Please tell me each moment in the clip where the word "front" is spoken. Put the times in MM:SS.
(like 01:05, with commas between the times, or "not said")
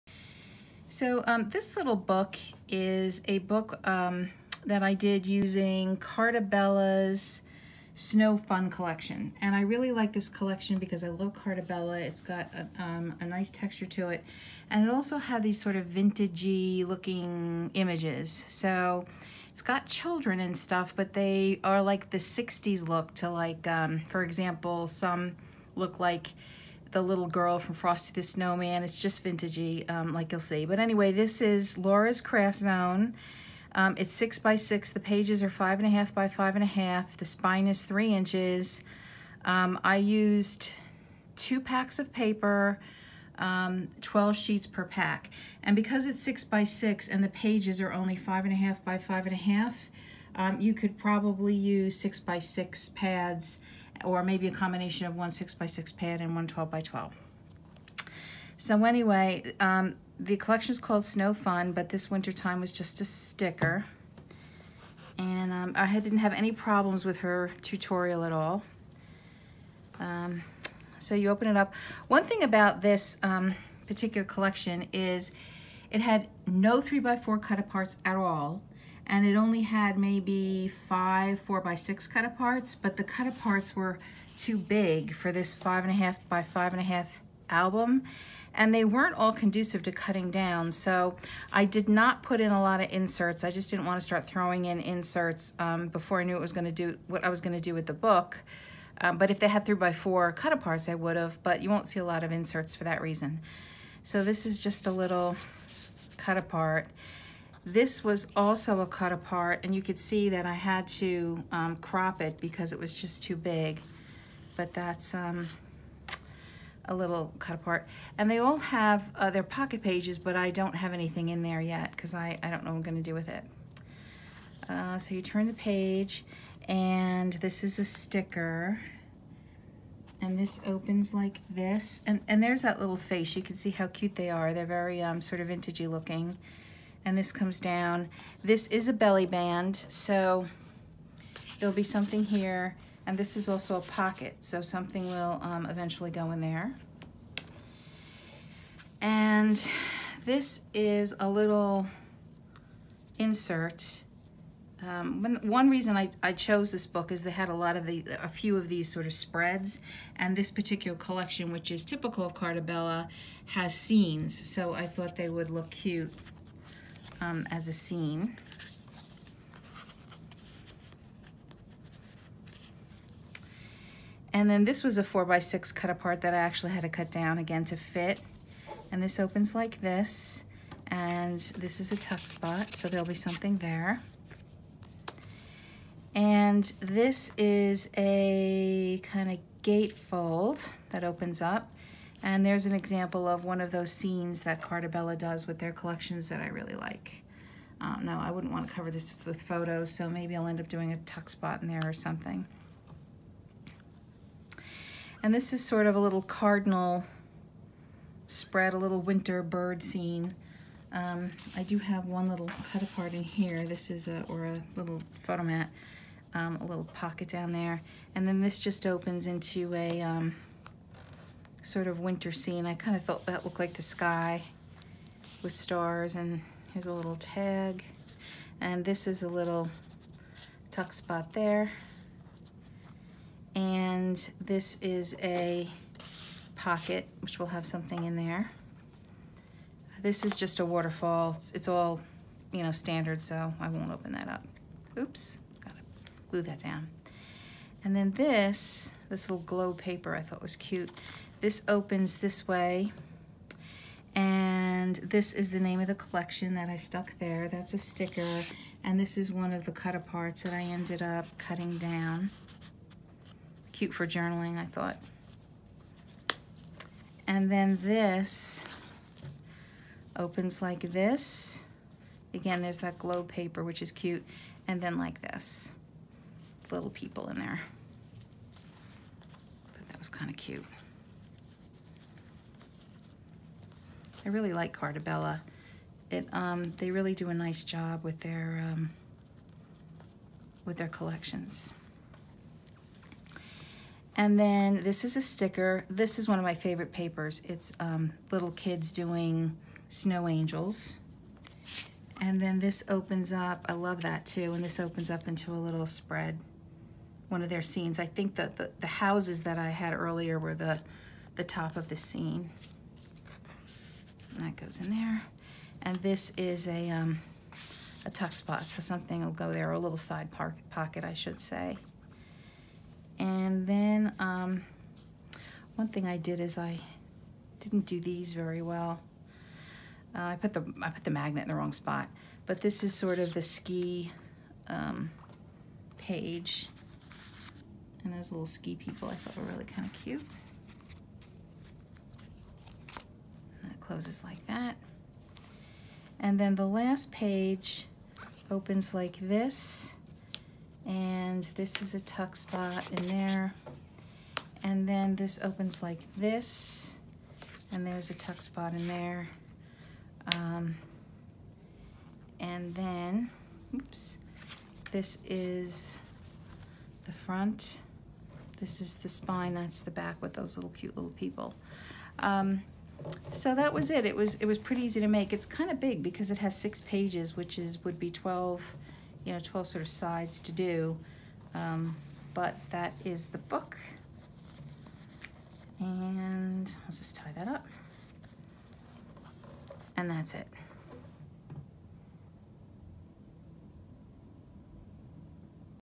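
06:07.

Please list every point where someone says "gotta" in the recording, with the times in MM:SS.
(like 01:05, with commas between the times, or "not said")
04:05.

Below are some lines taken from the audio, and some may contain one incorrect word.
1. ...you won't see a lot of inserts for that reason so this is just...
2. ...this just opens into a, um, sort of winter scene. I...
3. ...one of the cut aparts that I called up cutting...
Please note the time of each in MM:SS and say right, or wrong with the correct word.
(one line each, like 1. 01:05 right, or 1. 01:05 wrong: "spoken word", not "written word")
1. 01:41 right
2. 03:38 right
3. 04:19 wrong: "ended", not "called".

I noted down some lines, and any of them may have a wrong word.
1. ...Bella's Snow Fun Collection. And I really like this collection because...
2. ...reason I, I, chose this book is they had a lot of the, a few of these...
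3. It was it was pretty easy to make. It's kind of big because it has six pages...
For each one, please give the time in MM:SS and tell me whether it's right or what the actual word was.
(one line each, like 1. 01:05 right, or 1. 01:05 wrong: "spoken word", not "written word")
1. 00:06 right
2. 02:35 right
3. 06:14 right.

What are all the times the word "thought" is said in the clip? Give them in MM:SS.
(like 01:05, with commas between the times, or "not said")
02:44, 03:43, 04:10, 04:24, 05:39.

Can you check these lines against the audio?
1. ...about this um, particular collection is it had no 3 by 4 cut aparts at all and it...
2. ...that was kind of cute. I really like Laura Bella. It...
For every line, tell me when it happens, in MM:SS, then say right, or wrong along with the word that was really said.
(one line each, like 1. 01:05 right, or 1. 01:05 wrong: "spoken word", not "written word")
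1. 01:12 right
2. 04:39 wrong: "Carta", not "Laura".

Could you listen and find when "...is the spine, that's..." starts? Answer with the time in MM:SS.
06:08.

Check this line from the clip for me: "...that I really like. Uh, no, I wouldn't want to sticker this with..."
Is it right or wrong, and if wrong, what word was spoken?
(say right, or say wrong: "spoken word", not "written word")
wrong: "cover", not "sticker".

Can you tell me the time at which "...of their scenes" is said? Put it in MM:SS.
05:07.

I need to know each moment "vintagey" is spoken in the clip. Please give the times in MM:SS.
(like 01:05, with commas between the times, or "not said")
00:15, 00:29, 02:15.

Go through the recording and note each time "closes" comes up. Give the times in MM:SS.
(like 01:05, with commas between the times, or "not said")
05:43.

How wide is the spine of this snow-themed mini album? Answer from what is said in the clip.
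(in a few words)
3 inches.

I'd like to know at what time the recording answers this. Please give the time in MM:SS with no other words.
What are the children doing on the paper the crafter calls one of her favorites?
04:59.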